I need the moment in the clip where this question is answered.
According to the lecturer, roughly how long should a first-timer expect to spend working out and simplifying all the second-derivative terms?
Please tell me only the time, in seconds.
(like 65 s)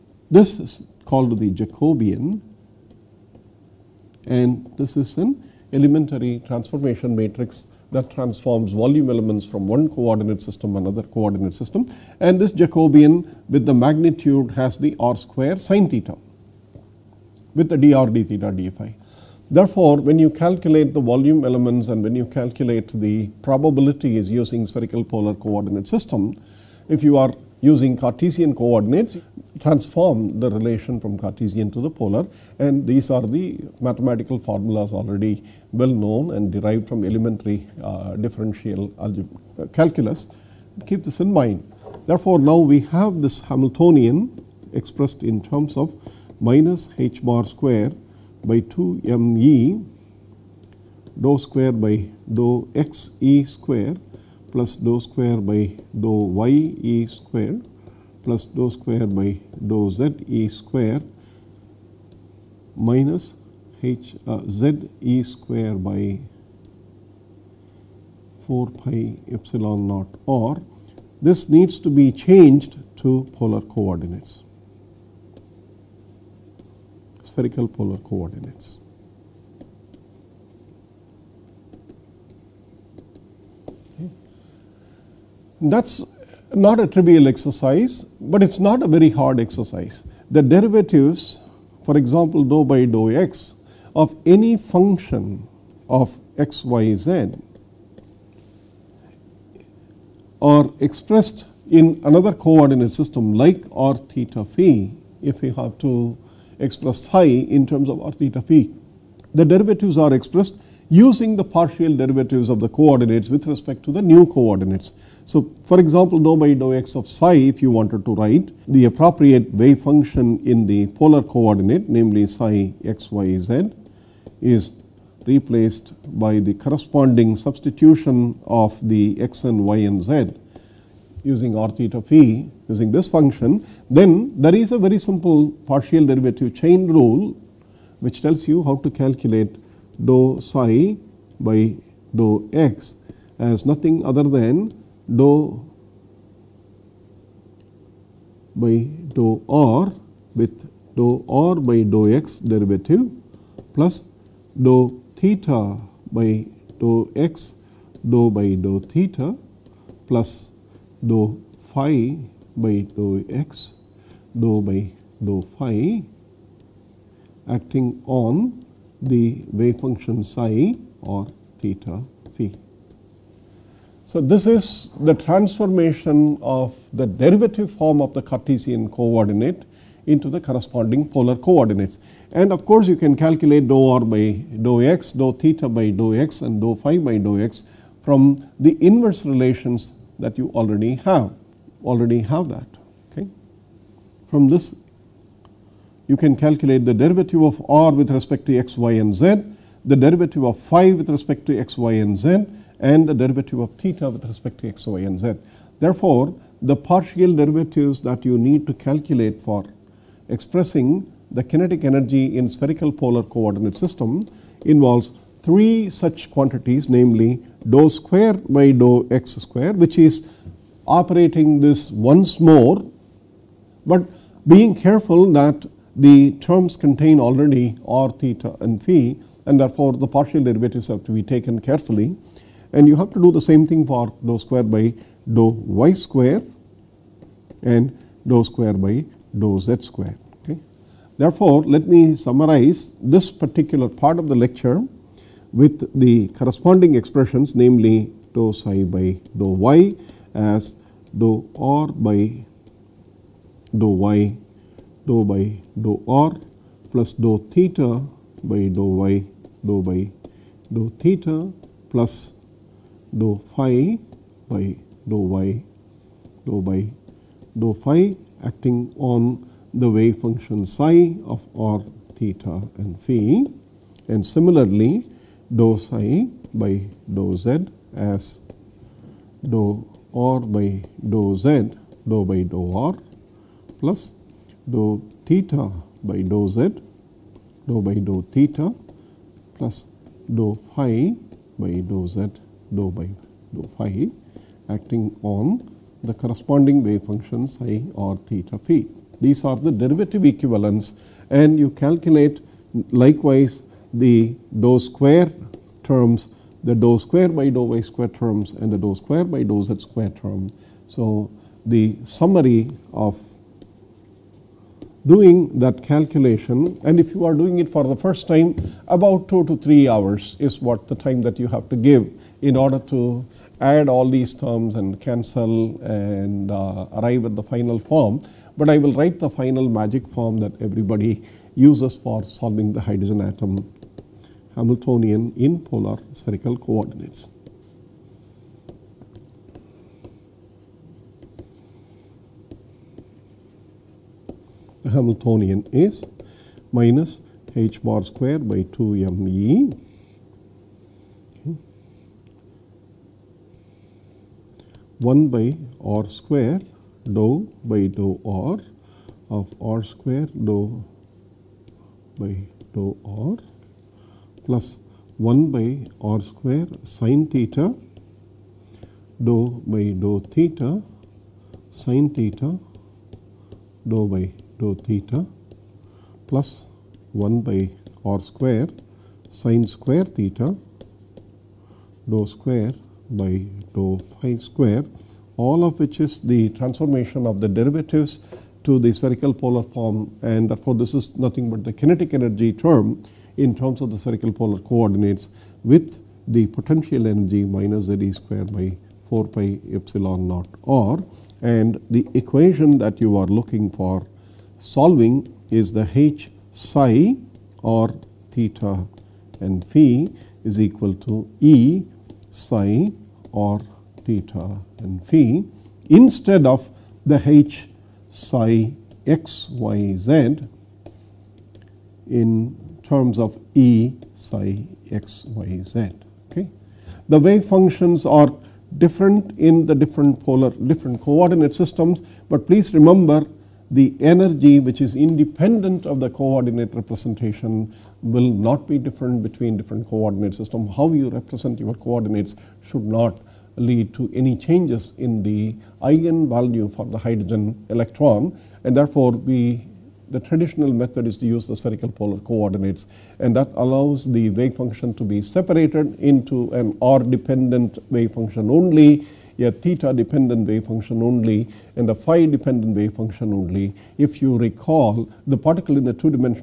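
319 s.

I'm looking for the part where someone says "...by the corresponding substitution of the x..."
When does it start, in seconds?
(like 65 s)
126 s.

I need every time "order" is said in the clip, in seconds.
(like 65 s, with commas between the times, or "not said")
322 s.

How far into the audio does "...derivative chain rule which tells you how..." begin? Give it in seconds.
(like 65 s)
136 s.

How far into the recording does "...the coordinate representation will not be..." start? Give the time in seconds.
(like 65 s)
435 s.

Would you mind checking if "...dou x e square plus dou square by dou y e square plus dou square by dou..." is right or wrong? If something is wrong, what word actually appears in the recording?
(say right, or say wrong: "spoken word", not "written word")
right.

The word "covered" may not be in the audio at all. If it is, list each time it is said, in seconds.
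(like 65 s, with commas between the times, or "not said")
not said.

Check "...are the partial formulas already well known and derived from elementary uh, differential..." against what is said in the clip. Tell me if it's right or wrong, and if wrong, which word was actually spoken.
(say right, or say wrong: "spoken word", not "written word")
wrong: "mathematical", not "partial".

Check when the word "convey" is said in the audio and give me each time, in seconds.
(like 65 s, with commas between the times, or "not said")
not said.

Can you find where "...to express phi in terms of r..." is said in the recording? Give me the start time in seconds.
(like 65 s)
105 s.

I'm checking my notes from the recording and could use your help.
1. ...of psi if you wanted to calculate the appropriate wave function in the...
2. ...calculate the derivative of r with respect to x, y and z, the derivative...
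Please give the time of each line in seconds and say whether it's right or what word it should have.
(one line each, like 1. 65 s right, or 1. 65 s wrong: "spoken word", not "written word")
1. 116 s wrong: "write", not "calculate"
2. 196 s right.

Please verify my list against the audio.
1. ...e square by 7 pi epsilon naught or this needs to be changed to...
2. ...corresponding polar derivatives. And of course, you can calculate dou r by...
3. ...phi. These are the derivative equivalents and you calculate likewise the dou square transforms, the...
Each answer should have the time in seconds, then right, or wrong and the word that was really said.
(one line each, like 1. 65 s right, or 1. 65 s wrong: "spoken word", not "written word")
1. 64 s wrong: "4", not "7"
2. 180 s wrong: "coordinates", not "derivatives"
3. 298 s wrong: "terms", not "transforms".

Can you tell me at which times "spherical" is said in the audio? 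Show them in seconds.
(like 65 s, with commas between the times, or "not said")
24 s, 77 s, 212 s, 336 s, 388 s, 393 s, 451 s.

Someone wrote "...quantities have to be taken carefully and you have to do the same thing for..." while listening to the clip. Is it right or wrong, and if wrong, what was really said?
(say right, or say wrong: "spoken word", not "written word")
wrong: "derivatives", not "quantities".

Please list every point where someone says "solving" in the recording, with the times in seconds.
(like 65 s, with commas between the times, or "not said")
332 s, 404 s.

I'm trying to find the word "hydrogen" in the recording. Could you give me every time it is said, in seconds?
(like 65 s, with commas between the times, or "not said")
332 s, 446 s.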